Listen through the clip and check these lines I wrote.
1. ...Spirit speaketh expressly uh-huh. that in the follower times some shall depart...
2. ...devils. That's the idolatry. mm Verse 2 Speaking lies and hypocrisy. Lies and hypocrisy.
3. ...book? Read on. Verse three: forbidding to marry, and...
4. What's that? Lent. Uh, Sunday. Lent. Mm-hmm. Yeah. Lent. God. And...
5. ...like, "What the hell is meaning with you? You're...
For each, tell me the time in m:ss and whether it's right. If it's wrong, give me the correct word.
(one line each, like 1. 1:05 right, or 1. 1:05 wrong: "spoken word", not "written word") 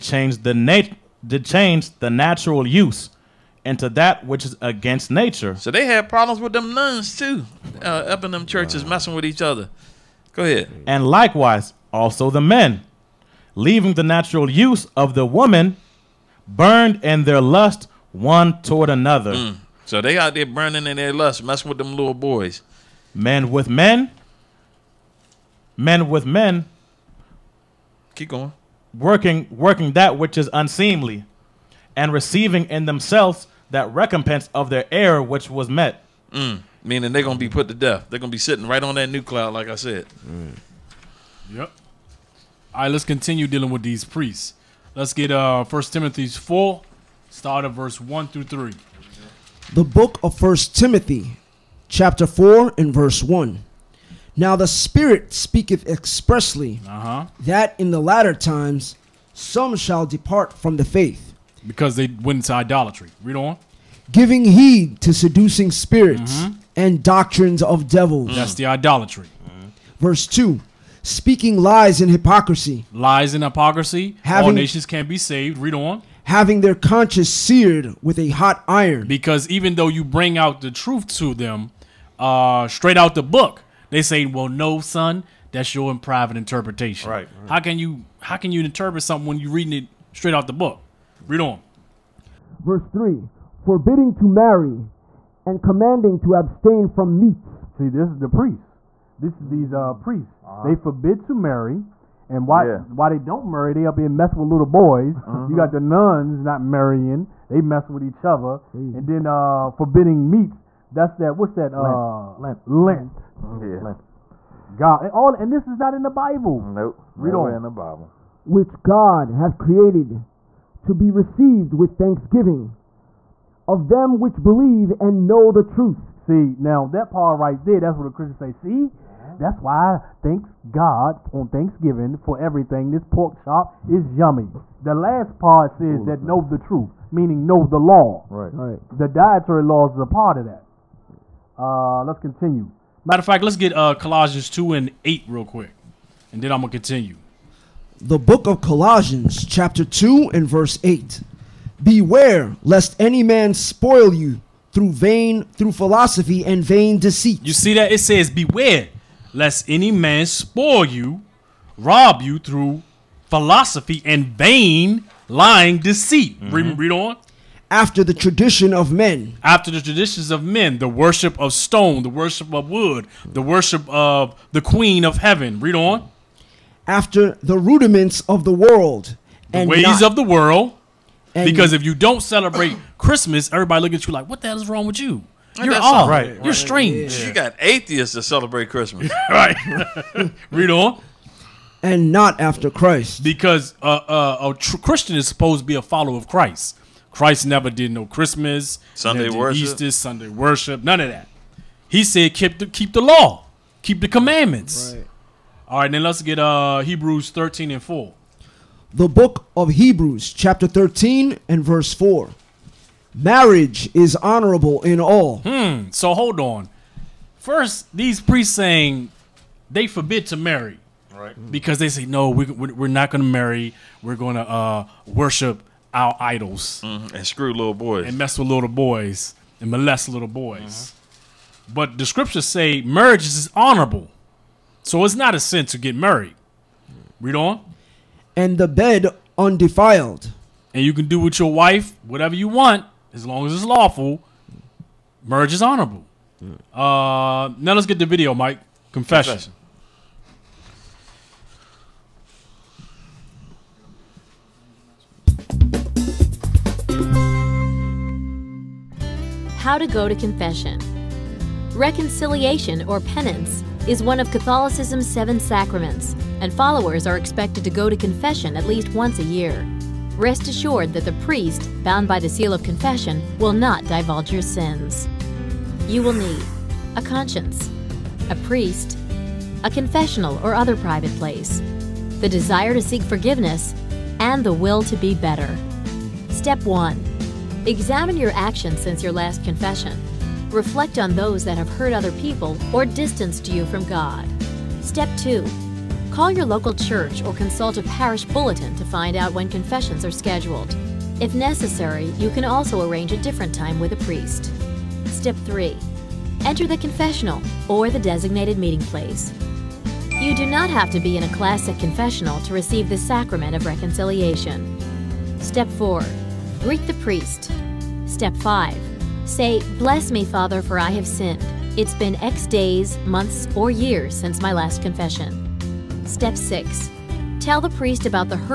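1. 0:54 wrong: "latter", not "follower"
2. 1:07 right
3. 1:30 right
4. 1:51 wrong: "Lent", not "Sunday"
5. 3:04 wrong: "wrong", not "meaning".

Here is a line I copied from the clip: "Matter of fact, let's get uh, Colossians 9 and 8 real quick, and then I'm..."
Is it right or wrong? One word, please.
wrong.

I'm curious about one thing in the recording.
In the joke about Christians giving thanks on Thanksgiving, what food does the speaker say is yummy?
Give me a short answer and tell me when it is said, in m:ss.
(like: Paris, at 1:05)
pork chop, at 2:13.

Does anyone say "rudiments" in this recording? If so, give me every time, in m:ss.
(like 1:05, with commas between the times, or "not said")
2:57.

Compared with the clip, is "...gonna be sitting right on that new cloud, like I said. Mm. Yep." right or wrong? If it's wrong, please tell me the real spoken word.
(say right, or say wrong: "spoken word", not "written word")
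right.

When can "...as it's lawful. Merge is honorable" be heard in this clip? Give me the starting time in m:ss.
4:03.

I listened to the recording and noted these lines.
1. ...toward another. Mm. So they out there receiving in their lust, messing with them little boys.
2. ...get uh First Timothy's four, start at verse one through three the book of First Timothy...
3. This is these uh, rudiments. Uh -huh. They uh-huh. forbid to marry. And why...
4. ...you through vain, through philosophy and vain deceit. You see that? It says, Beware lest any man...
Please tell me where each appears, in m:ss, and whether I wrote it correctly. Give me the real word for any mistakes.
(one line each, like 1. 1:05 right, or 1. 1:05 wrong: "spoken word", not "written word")
1. 0:18 wrong: "burning", not "receiving"
2. 0:45 right
3. 1:39 wrong: "priests", not "rudiments"
4. 2:34 right.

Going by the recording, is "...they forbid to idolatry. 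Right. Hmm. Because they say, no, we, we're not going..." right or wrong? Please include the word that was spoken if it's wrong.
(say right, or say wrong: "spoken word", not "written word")
wrong: "marry", not "idolatry".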